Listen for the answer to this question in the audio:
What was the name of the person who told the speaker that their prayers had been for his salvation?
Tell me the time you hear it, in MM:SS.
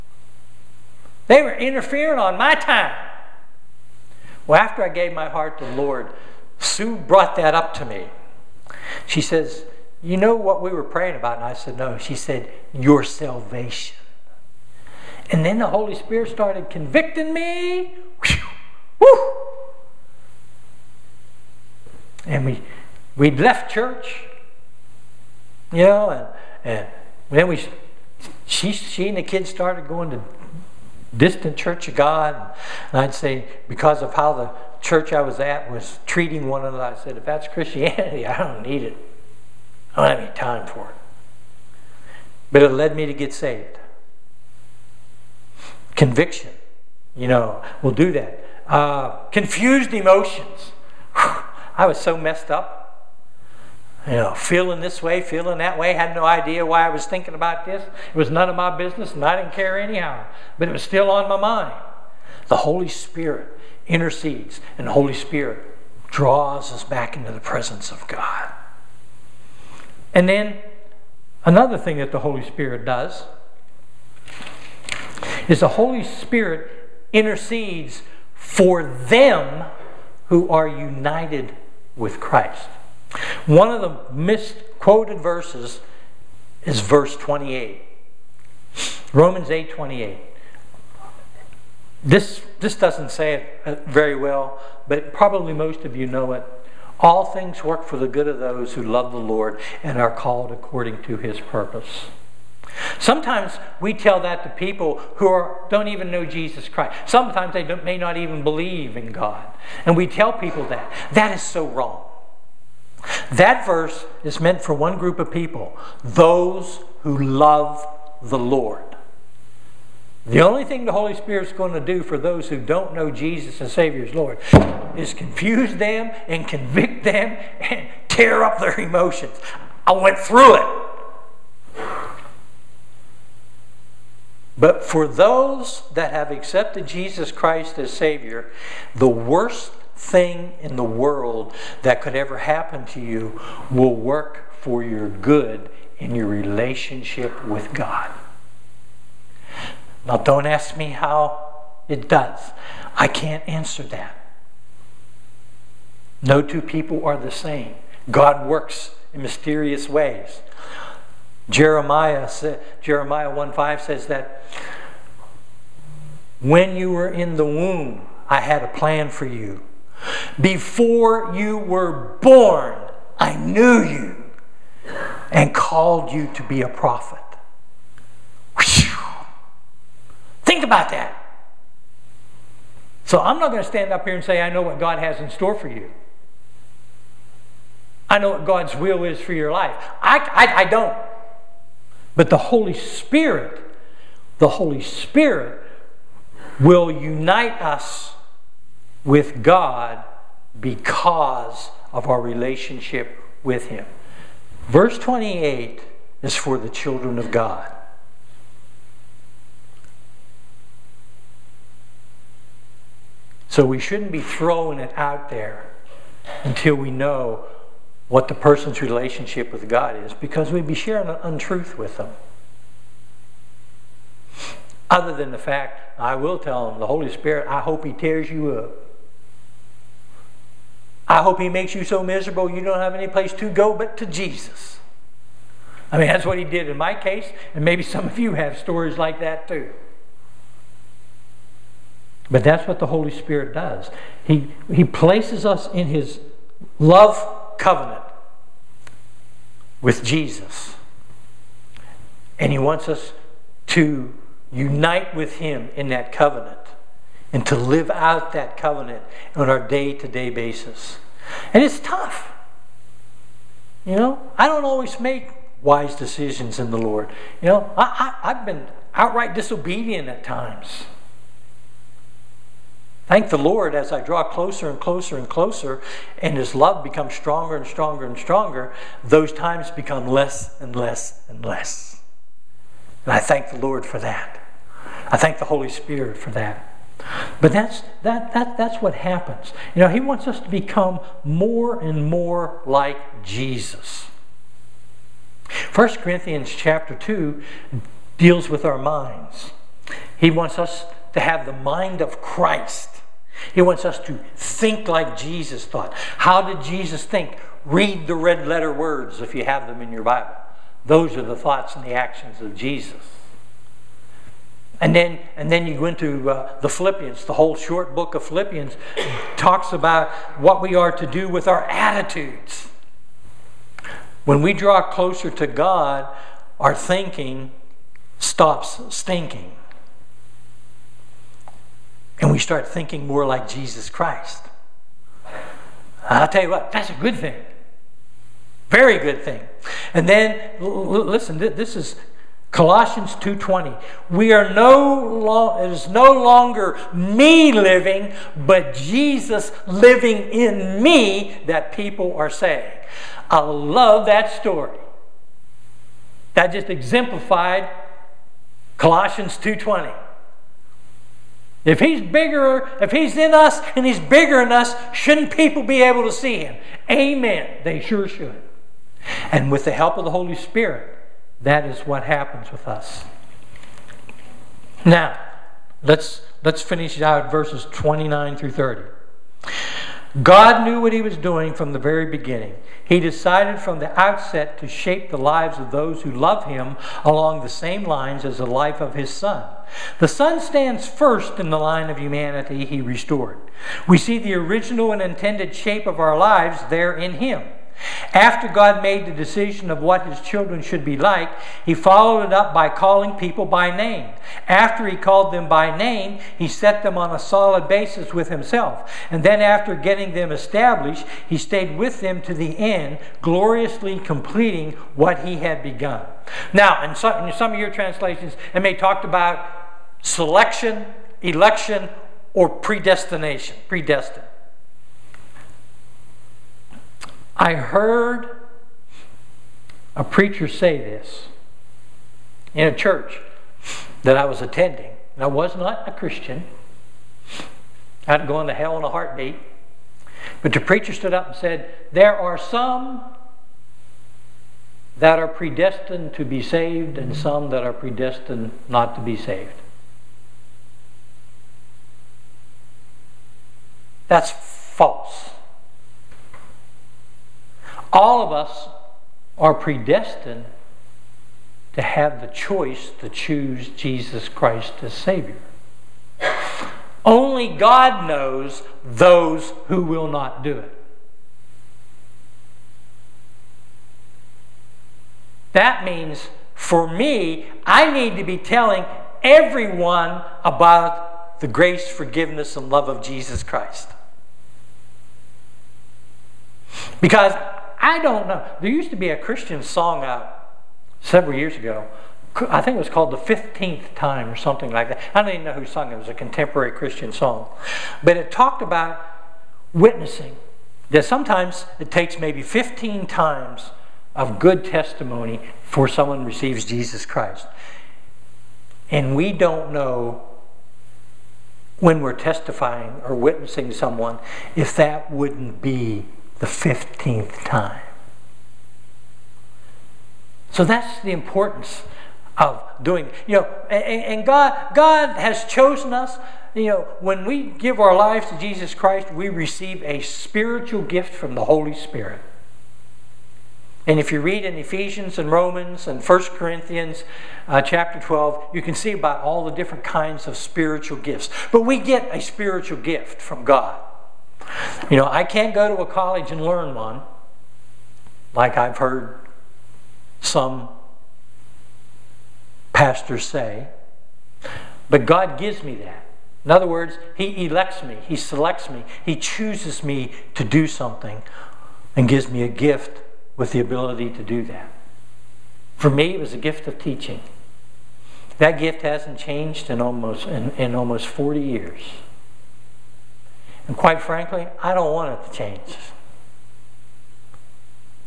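00:06.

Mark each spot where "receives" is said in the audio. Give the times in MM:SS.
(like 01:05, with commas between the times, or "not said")
08:26, 08:49.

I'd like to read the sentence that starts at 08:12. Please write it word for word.
I think it was called The 15th Time or something like that.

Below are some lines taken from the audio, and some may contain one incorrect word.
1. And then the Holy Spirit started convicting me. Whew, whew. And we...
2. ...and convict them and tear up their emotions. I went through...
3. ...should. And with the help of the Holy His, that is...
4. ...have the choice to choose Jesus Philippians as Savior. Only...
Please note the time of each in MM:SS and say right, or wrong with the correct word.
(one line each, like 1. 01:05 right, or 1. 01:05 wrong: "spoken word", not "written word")
1. 00:15 right
2. 02:06 right
3. 06:08 wrong: "Spirit", not "His"
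4. 07:41 wrong: "Christ", not "Philippians".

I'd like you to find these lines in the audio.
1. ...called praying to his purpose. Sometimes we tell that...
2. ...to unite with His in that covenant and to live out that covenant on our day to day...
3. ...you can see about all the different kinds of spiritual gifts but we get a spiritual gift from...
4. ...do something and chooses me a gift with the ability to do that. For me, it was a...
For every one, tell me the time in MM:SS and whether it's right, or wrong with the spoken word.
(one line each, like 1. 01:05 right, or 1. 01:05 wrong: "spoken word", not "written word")
1. 01:40 wrong: "according", not "praying"
2. 04:13 wrong: "Him", not "His"
3. 08:58 right
4. 09:20 wrong: "gives", not "chooses".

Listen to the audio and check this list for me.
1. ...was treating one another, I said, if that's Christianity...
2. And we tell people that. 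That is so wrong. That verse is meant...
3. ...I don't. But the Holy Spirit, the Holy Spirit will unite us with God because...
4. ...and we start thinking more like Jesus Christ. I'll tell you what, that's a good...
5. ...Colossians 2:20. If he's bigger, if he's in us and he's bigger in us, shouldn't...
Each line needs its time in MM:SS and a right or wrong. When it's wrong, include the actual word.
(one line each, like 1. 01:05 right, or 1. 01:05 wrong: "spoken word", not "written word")
1. 00:35 right
2. 01:49 right
3. 03:10 right
4. 05:32 right
5. 05:58 right.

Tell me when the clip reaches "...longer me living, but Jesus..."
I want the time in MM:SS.
05:46.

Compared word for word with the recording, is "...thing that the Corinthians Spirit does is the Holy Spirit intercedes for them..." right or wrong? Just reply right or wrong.
wrong.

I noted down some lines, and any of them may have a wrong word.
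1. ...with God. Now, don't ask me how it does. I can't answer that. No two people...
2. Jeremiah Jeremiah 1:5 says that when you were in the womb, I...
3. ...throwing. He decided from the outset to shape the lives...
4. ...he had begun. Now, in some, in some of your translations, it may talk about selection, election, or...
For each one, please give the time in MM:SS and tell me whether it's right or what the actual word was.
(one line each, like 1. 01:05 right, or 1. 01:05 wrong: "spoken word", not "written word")
1. 02:27 right
2. 02:41 right
3. 06:22 wrong: "beginning", not "throwing"
4. 06:55 right.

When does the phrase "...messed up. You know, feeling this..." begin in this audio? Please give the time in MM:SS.
00:52.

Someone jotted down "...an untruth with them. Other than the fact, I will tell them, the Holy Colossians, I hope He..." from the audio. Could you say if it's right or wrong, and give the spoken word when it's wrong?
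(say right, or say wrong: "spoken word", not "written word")
wrong: "Spirit", not "Colossians".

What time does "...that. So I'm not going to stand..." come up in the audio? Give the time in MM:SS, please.
03:00.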